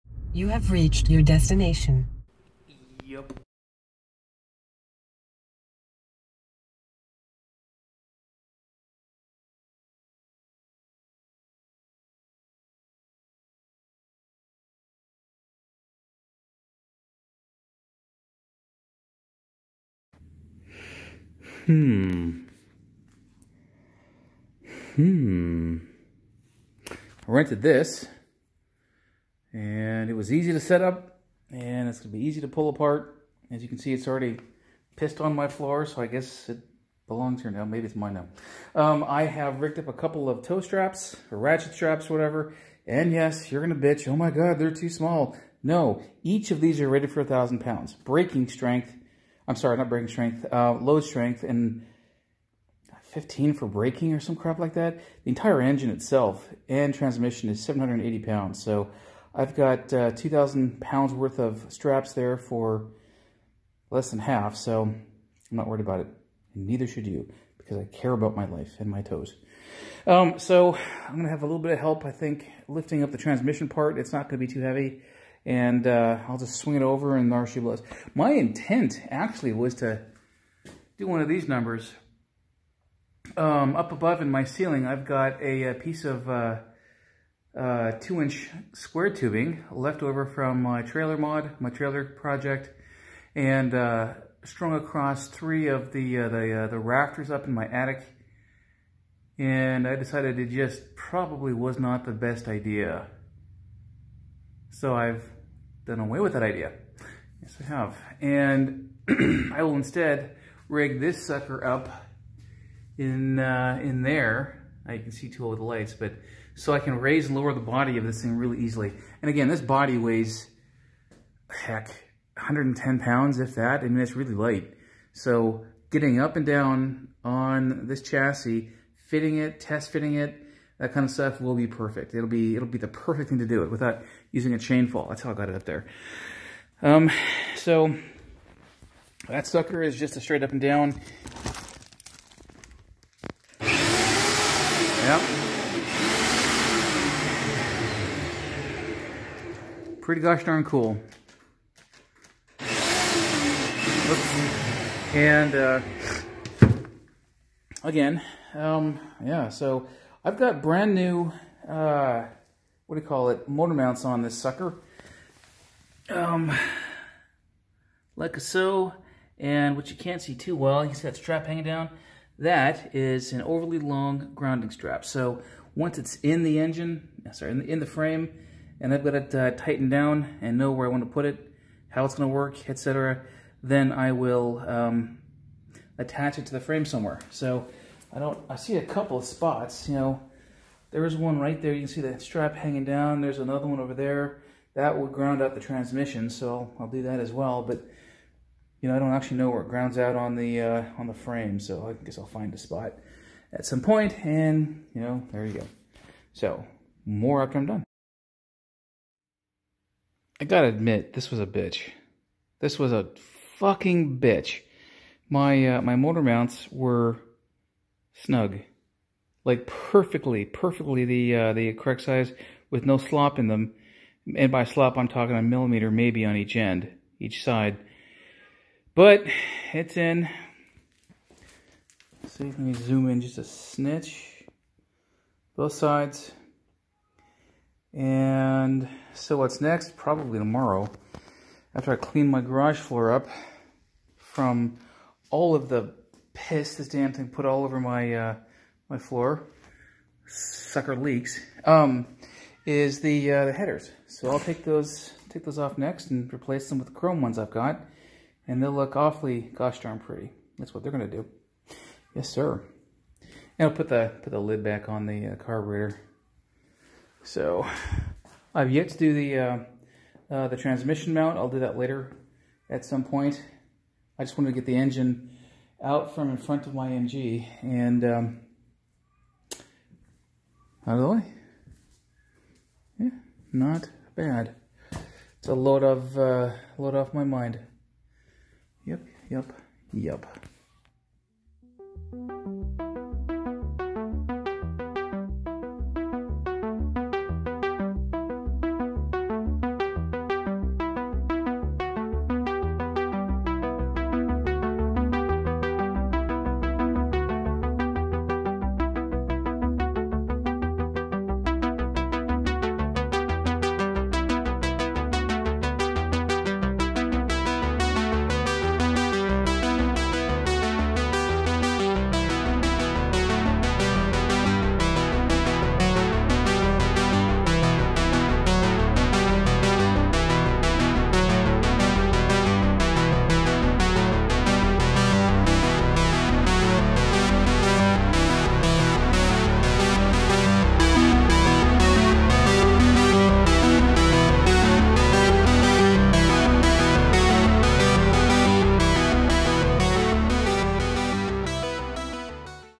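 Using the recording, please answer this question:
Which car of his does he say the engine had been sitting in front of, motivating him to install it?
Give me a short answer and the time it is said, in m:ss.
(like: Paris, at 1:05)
MG, at 4:36.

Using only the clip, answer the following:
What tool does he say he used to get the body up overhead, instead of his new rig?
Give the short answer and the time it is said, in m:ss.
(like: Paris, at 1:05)
a chain fall, at 2:14.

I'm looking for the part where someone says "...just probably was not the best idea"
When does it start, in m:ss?
1:40.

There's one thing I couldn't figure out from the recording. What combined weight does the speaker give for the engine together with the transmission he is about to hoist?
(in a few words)
780 pounds.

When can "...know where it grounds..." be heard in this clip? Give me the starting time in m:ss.
3:19.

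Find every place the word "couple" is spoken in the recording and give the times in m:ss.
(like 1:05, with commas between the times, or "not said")
0:39, 3:08.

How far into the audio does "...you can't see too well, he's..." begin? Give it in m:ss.
2:49.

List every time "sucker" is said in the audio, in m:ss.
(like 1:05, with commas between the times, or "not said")
1:51, 2:19, 2:44, 4:10.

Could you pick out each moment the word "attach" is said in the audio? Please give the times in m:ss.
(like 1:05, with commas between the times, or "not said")
3:05.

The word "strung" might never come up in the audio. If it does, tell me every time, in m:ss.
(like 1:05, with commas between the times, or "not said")
1:34.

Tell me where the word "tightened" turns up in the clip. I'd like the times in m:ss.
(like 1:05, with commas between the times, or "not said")
2:59.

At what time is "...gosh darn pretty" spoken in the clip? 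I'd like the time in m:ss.
4:19.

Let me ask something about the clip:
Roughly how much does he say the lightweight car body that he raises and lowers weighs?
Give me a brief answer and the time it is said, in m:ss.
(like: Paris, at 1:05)
110 pounds, at 2:02.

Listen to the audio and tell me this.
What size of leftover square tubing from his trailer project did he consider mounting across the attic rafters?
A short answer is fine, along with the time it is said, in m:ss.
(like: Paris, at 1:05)
two inch, at 1:27.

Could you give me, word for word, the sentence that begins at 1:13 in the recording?
It's not going to be too heavy.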